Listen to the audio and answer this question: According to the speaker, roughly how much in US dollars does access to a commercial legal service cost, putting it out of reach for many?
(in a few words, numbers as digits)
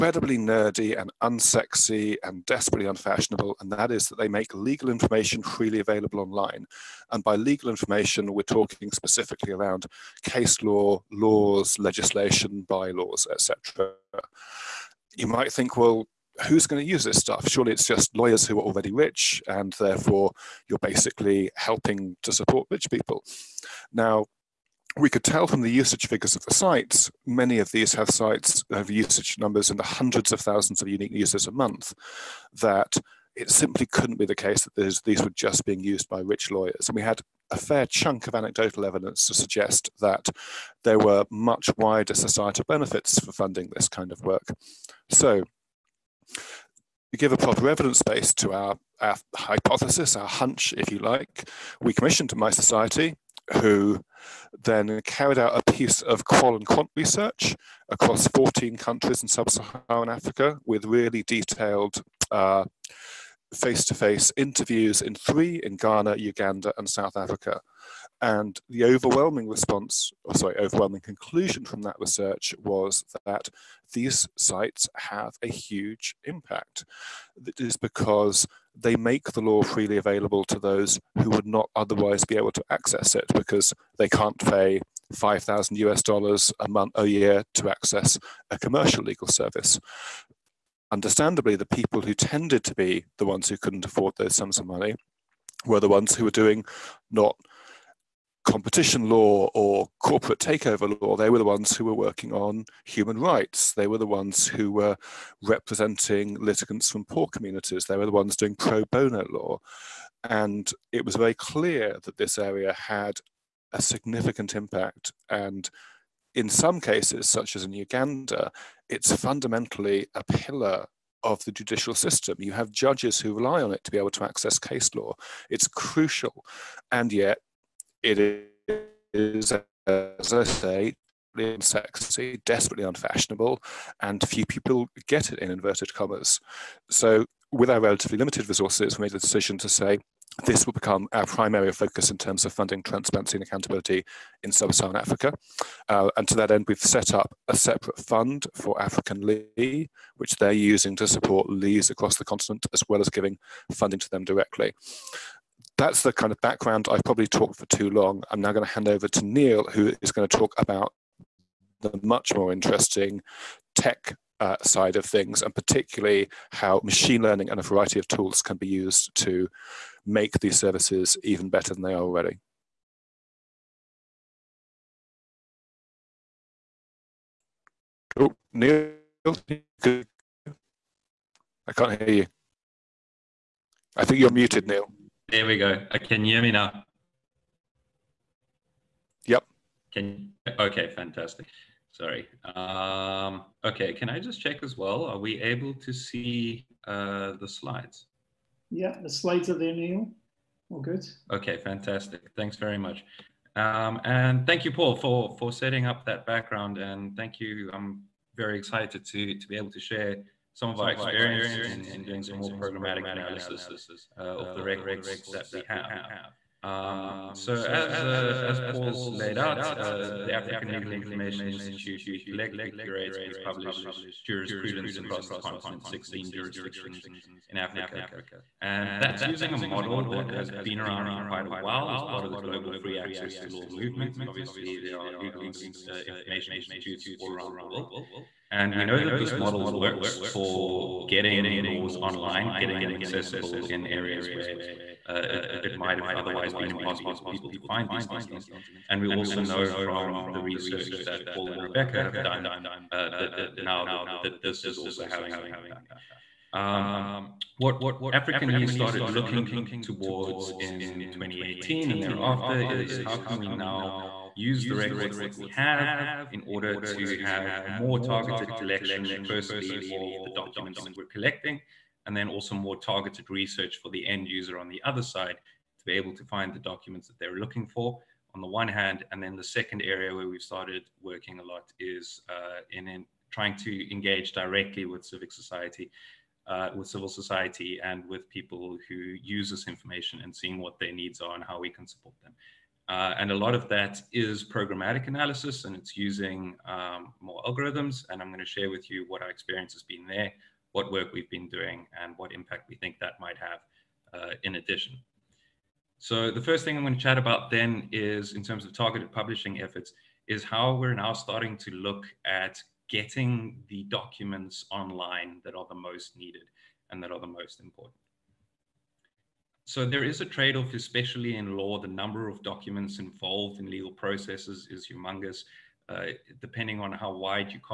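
5,000 US dollars.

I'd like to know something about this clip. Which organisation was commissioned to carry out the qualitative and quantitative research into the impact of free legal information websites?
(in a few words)
mySociety.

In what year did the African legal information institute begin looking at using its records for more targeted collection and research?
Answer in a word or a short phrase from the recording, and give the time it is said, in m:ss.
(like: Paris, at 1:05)
2018, at 4:21.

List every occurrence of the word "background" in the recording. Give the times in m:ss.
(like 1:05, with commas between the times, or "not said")
2:36, 3:26.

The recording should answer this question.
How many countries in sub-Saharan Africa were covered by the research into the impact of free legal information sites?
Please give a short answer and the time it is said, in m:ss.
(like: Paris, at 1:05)
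14, at 0:58.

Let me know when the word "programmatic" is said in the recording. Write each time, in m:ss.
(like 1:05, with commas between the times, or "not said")
3:32, 4:54.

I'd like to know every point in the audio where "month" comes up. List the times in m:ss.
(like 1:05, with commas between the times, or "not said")
0:31, 1:26.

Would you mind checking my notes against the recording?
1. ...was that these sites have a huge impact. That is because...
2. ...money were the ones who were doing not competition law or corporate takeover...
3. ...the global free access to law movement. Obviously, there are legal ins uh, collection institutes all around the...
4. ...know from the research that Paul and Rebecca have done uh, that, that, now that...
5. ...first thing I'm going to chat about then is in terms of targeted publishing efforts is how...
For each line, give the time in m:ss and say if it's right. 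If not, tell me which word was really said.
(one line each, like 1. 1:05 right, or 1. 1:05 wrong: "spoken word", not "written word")
1. 1:12 right
2. 1:34 right
3. 3:52 wrong: "information", not "collection"
4. 4:09 right
5. 5:06 right.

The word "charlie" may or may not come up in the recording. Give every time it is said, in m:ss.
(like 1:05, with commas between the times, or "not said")
not said.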